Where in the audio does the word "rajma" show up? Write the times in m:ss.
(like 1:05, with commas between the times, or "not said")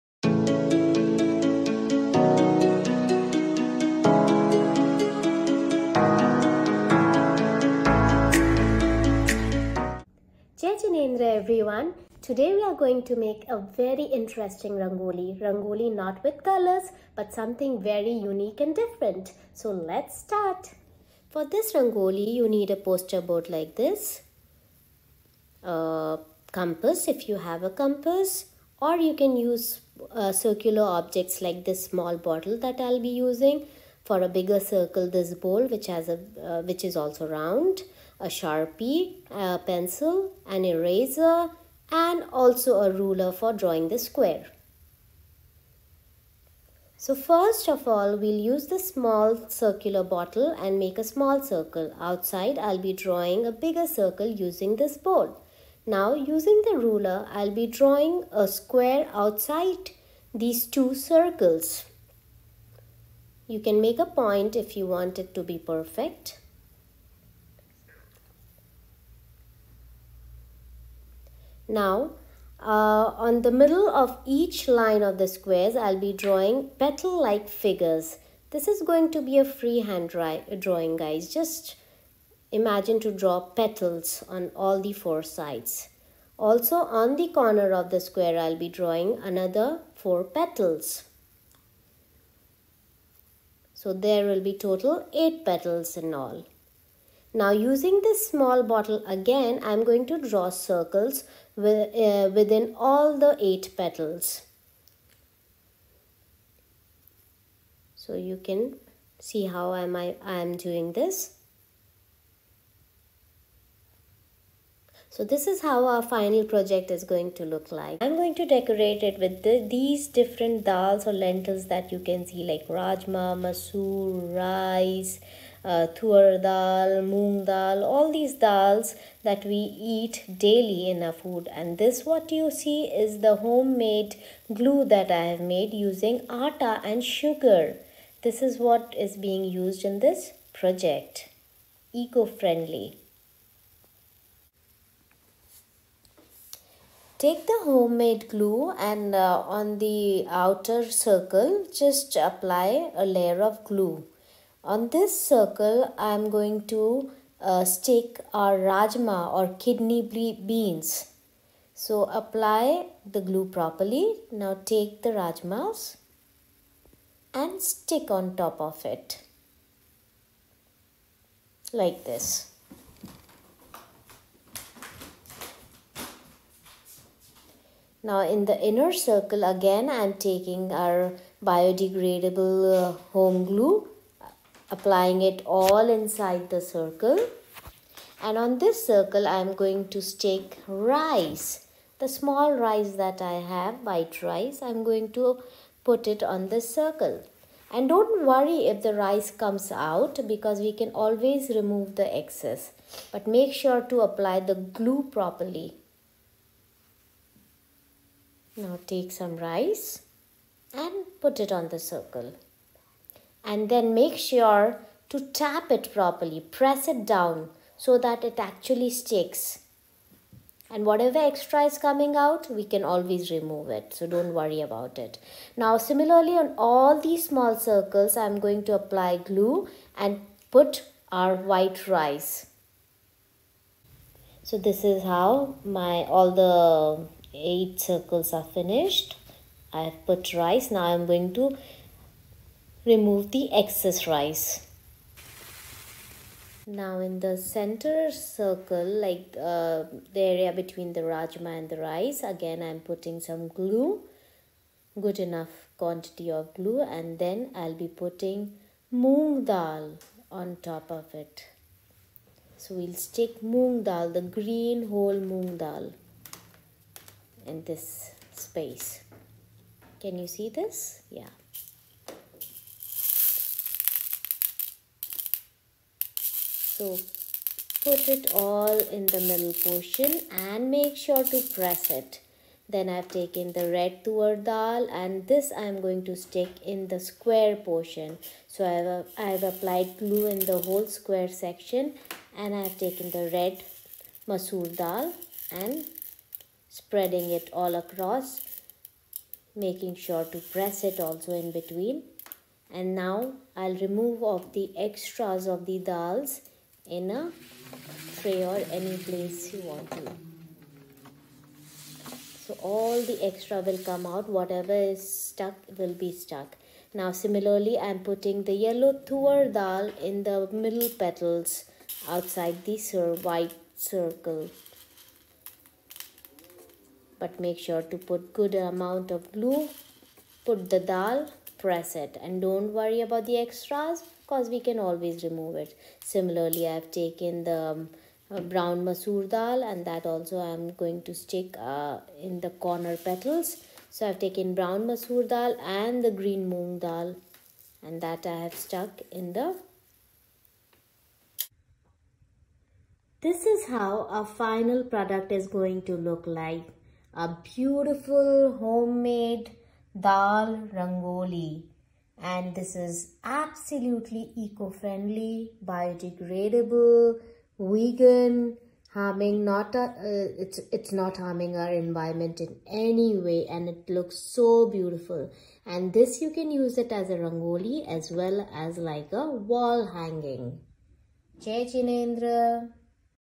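2:02, 2:38, 2:45, 4:11.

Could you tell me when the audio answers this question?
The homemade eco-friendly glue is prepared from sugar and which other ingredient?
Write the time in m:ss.
2:16.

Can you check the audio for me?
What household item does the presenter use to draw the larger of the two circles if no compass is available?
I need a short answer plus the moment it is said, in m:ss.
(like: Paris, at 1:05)
bowl, at 0:35.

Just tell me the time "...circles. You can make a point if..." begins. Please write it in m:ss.
1:00.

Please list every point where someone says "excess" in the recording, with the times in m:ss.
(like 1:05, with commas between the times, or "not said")
3:22, 4:03.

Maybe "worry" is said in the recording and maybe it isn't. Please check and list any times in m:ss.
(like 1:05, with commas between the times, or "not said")
3:18, 3:44, 5:32.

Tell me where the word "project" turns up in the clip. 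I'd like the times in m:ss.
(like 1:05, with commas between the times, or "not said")
1:56, 2:20.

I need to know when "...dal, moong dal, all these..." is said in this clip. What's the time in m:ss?
2:06.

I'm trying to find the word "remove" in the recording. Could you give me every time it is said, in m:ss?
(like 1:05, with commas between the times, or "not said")
3:21, 3:43, 4:02, 5:03, 5:35.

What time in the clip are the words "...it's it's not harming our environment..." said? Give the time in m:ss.
6:10.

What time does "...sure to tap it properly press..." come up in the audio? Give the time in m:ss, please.
3:34.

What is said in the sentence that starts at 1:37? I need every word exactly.
Now using this small bottle again, I'm going to draw circles with, uh, within all the eight petals.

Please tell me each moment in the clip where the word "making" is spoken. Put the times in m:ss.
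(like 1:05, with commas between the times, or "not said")
4:59.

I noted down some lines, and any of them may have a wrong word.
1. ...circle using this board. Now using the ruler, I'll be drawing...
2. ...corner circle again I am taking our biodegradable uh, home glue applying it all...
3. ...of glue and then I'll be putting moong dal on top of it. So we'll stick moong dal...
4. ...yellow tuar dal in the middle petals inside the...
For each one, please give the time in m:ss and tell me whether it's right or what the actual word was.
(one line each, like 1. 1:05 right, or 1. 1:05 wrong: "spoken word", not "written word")
1. 0:53 right
2. 2:58 wrong: "inner", not "corner"
3. 4:16 right
4. 5:18 wrong: "outside", not "inside".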